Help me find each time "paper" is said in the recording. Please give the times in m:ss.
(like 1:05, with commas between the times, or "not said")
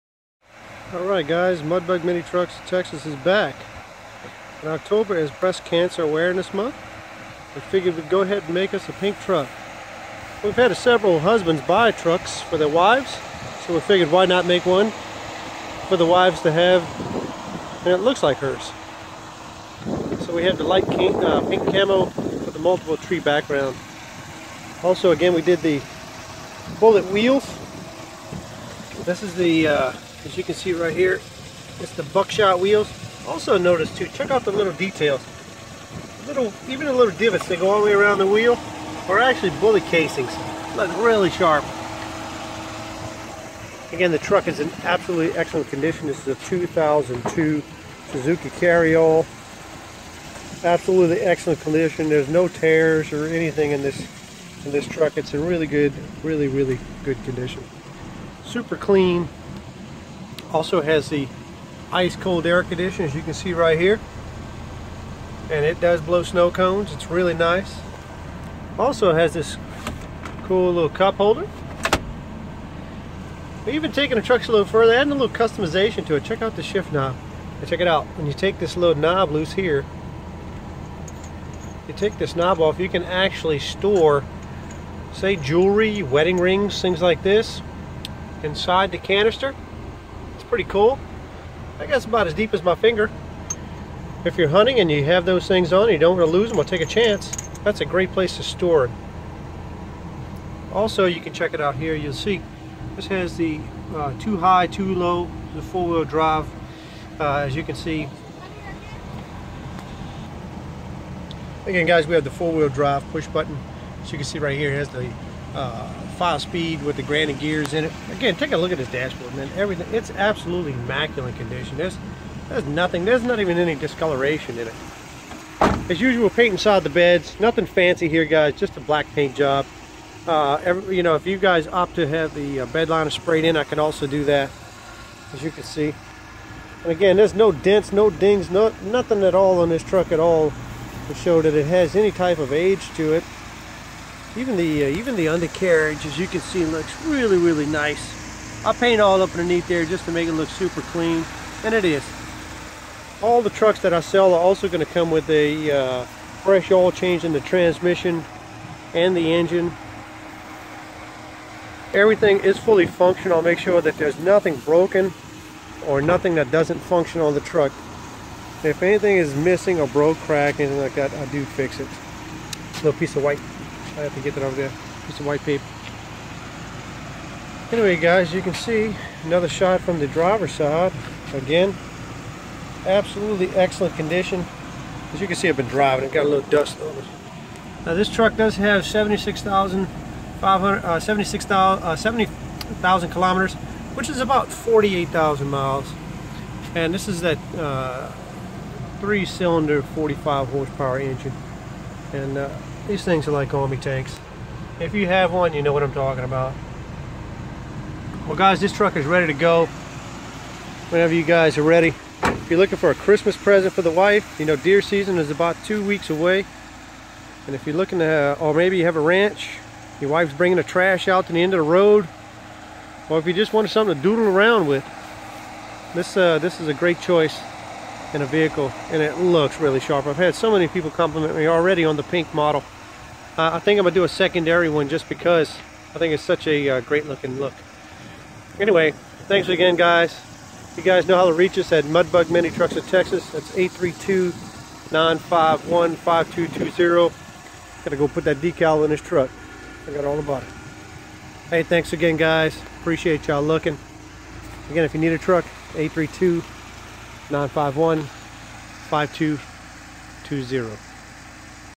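2:55.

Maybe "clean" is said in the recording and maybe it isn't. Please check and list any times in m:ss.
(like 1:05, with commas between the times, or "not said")
0:58, 2:30.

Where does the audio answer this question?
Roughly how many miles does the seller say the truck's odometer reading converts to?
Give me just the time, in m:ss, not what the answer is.
3:14.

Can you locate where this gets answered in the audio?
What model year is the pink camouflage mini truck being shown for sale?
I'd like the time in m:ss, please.
0:46.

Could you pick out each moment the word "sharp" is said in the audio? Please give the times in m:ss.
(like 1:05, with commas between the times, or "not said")
0:41, 3:49.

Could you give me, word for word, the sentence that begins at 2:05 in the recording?
As usual, paint inside the beds.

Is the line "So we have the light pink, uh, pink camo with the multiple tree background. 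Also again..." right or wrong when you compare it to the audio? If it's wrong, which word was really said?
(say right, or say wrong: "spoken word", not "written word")
right.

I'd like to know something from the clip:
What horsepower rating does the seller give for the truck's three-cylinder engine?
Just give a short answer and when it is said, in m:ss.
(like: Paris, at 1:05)
45, at 3:19.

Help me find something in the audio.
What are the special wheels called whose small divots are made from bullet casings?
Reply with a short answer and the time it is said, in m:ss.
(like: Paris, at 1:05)
buckshot wheels, at 0:32.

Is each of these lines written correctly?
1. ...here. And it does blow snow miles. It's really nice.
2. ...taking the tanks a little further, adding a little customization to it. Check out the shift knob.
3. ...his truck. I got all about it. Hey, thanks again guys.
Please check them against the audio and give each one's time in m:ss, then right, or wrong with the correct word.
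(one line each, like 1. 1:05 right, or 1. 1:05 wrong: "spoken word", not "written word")
1. 1:03 wrong: "cones", not "miles"
2. 1:13 wrong: "trucks", not "tanks"
3. 4:08 right.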